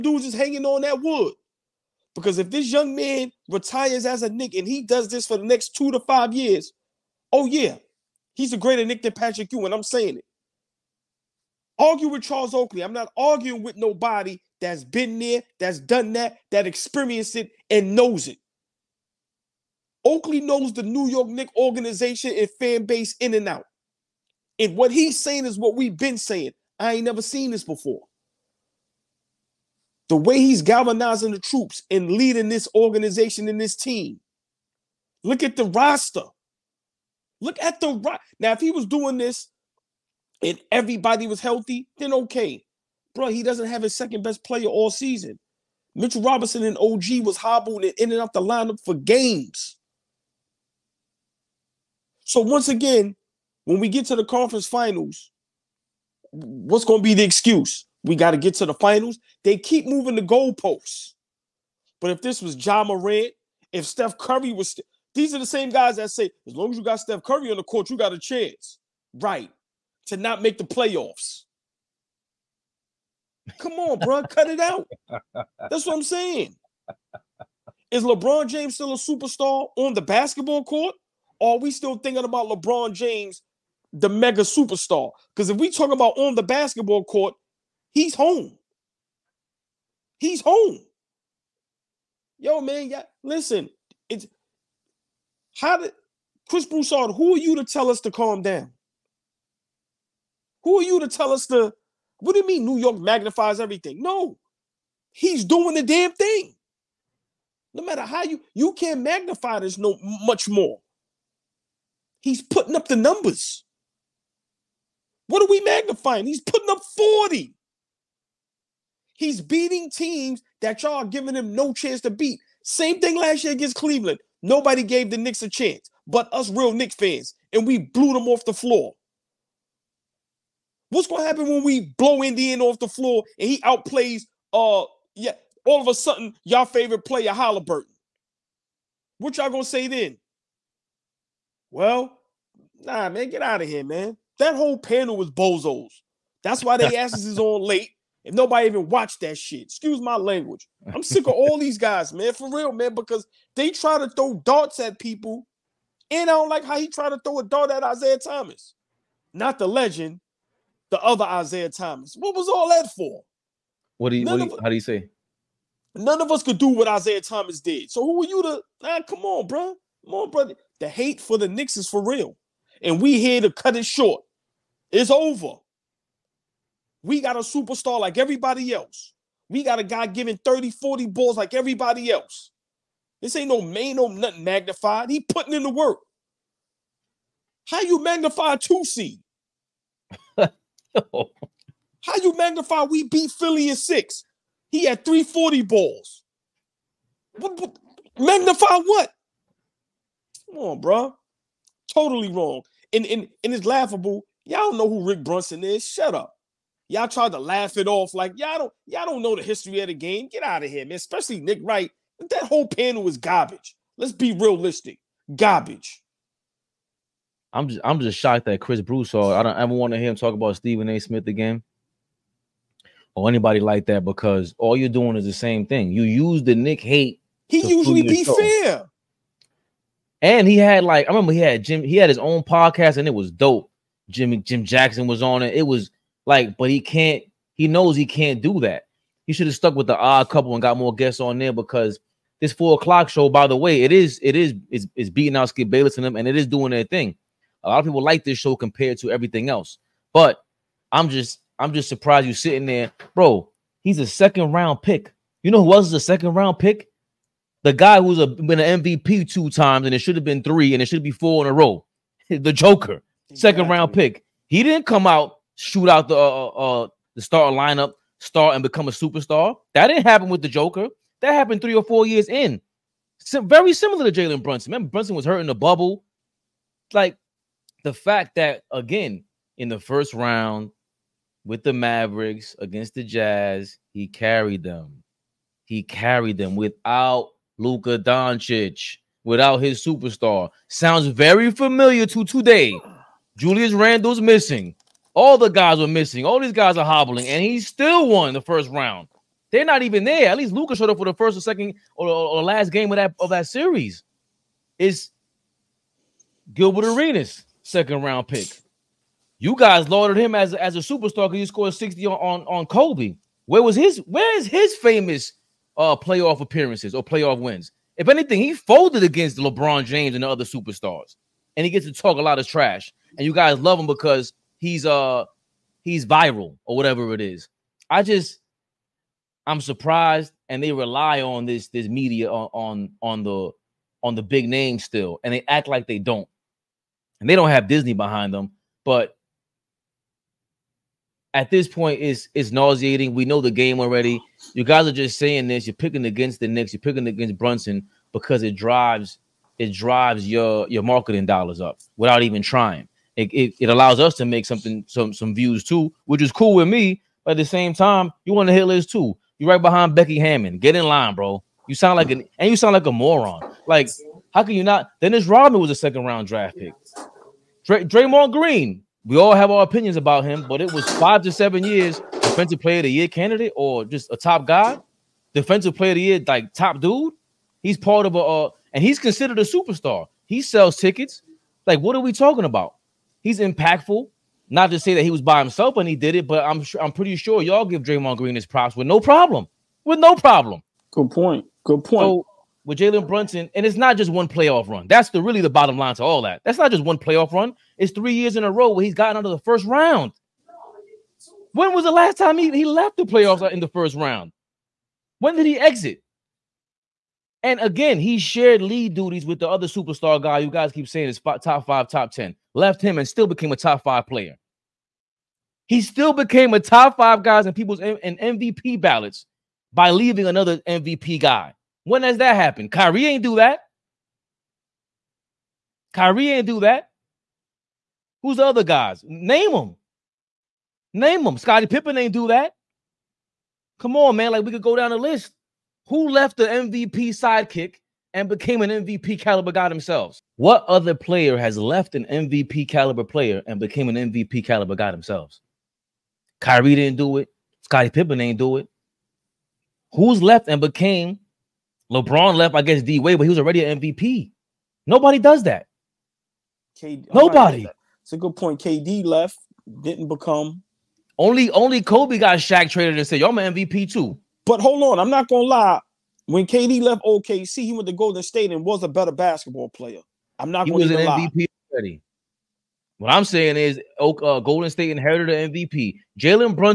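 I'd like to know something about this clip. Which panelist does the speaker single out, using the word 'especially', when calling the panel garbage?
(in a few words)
Nick Wright.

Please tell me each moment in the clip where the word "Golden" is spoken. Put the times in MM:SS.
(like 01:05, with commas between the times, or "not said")
07:47, 07:54.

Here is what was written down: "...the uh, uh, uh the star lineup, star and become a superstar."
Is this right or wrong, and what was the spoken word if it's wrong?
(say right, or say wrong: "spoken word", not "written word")
right.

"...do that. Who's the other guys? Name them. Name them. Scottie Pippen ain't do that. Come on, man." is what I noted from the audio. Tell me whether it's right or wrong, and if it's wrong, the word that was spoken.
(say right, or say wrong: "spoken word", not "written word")
right.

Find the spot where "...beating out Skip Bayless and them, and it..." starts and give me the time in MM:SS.
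04:05.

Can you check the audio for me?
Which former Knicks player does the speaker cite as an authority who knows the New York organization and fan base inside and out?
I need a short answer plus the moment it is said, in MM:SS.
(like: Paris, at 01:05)
Charles Oakley, at 00:12.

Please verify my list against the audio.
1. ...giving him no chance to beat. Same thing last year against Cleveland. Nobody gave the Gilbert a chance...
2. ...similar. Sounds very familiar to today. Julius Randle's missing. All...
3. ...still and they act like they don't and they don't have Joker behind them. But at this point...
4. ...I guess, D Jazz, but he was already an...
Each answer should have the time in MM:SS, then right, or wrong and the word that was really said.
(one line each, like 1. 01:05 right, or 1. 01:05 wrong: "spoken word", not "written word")
1. 02:01 wrong: "Knicks", not "Gilbert"
2. 04:49 wrong: "superstar", not "similar"
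3. 05:34 wrong: "Disney", not "Joker"
4. 07:32 wrong: "Wade", not "Jazz".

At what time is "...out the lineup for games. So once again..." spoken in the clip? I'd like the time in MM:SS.
00:48.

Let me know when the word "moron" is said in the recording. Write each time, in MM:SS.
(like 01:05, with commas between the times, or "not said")
06:02.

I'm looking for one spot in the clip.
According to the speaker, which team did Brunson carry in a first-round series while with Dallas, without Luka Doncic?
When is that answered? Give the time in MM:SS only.
04:42.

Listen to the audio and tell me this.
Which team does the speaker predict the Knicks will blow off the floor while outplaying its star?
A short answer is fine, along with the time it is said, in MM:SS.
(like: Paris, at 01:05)
Indiana, at 02:12.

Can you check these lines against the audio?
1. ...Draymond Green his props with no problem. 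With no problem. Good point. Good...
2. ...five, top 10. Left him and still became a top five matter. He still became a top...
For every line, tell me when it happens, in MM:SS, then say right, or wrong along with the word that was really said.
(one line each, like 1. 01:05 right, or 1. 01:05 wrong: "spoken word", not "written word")
1. 06:27 right
2. 06:51 wrong: "player", not "matter".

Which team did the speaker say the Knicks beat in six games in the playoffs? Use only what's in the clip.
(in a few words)
Philly.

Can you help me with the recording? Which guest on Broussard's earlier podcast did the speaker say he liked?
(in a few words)
Jim Jackson.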